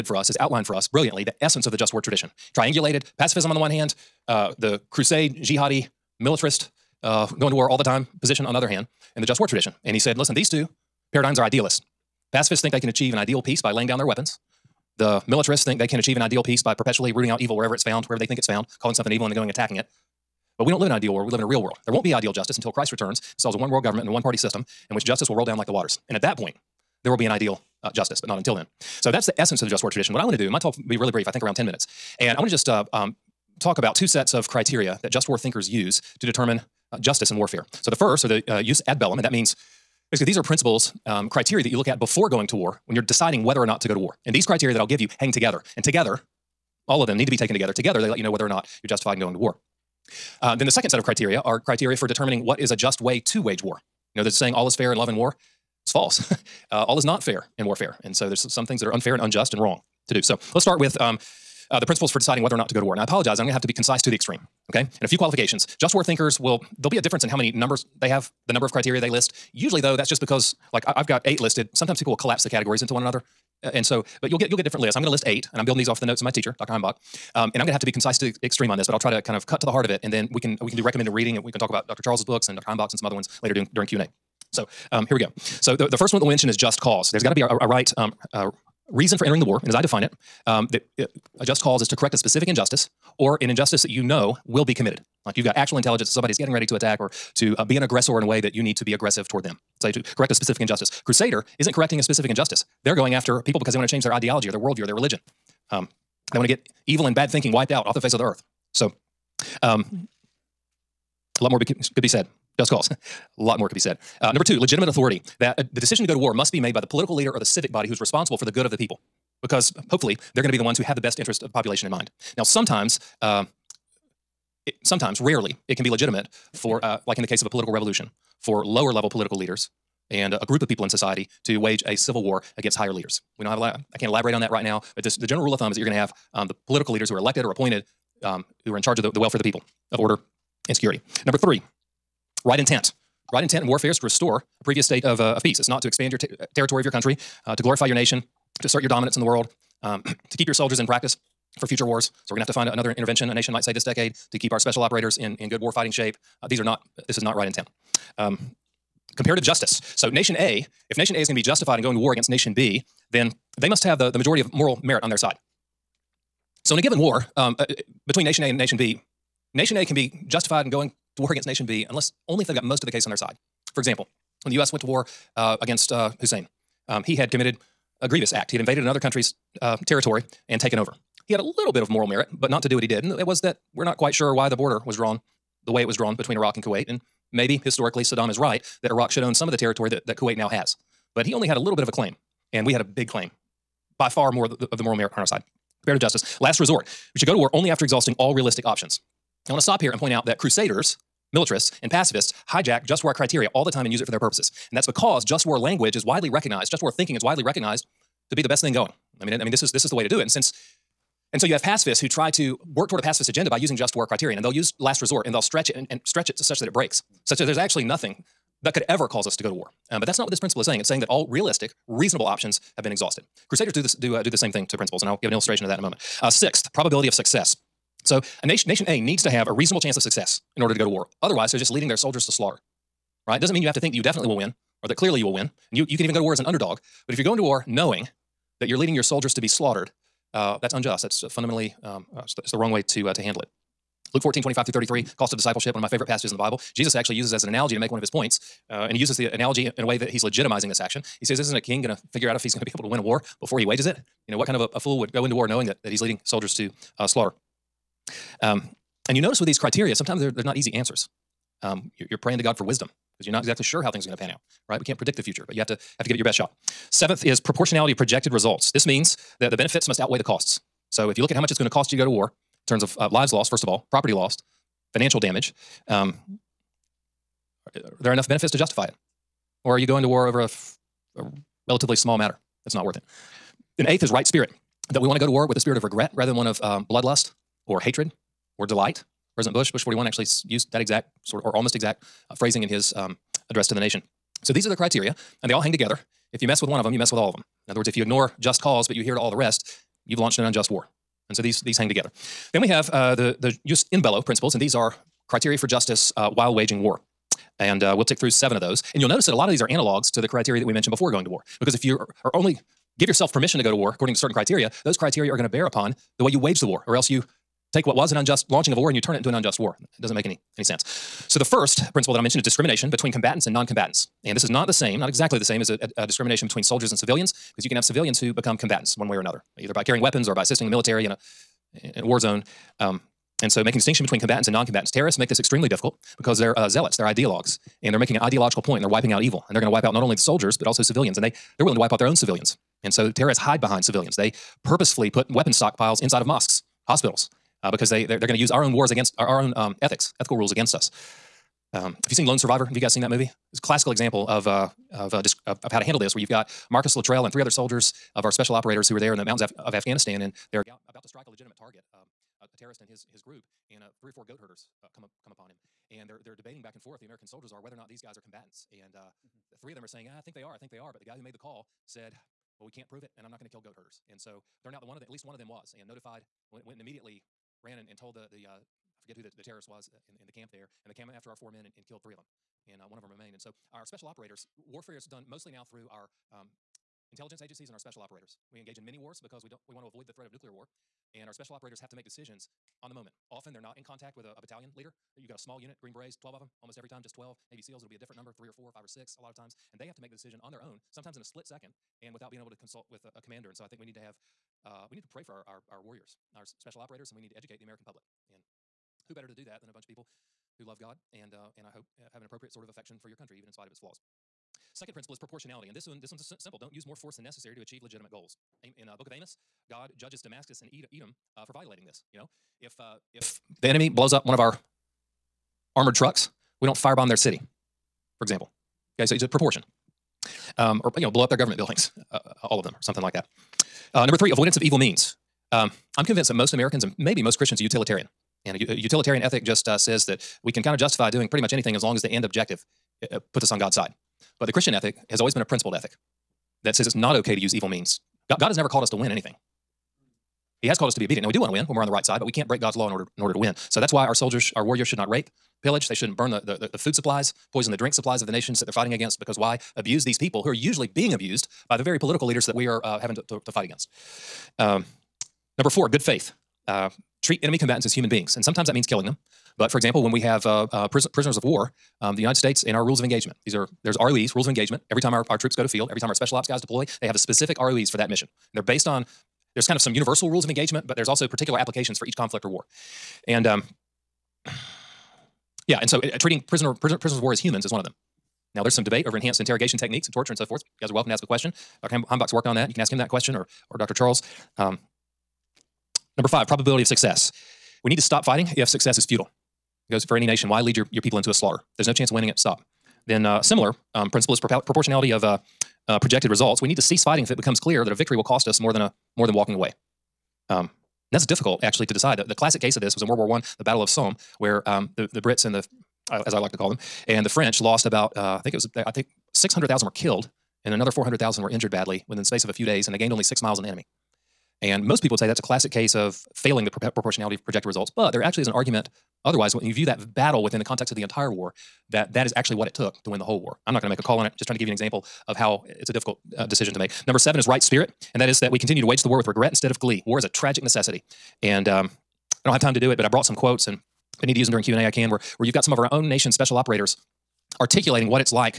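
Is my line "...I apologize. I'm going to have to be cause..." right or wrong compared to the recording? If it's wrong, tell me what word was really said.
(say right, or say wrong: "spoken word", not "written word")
wrong: "concise", not "cause".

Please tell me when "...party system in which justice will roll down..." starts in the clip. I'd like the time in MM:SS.
00:24.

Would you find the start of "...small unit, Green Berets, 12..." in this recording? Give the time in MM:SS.
06:35.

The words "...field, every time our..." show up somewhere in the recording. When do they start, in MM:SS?
07:55.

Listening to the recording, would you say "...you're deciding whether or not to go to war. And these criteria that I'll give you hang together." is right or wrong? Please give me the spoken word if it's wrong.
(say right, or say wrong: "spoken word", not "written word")
right.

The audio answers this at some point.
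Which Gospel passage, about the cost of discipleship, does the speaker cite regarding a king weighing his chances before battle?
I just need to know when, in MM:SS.
04:04.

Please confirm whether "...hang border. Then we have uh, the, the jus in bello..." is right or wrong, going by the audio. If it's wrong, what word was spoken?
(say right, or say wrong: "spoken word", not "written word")
wrong: "together", not "border".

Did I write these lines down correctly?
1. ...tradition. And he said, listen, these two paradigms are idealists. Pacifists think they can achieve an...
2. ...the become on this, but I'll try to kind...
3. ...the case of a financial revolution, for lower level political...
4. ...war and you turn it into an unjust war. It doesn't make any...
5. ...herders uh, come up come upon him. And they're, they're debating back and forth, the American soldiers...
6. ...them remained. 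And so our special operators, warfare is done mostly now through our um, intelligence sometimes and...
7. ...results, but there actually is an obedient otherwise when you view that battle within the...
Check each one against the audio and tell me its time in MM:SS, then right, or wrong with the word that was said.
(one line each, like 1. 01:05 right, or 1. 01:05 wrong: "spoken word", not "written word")
1. 00:09 right
2. 01:18 wrong: "extreme", not "become"
3. 02:07 wrong: "political", not "financial"
4. 05:18 right
5. 06:04 right
6. 06:23 wrong: "agencies", not "sometimes"
7. 08:47 wrong: "argument", not "obedient".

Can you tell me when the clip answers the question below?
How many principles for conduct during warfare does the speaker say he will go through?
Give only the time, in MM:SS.
05:08.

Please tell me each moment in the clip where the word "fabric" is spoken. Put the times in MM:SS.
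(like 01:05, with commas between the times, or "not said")
not said.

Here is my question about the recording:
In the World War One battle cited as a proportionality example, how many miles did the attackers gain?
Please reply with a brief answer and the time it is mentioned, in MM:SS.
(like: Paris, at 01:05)
6 miles, at 08:43.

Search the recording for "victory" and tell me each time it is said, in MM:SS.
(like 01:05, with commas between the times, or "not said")
08:27.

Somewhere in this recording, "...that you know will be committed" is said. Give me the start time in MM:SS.
01:33.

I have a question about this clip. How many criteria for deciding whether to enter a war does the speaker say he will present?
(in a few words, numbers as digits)
8.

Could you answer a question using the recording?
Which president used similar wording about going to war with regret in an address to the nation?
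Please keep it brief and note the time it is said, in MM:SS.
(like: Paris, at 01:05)
Bush 41, at 04:49.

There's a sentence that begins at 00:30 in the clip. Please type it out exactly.
What I want to do, my talk will be really brief, I think around 10 minutes.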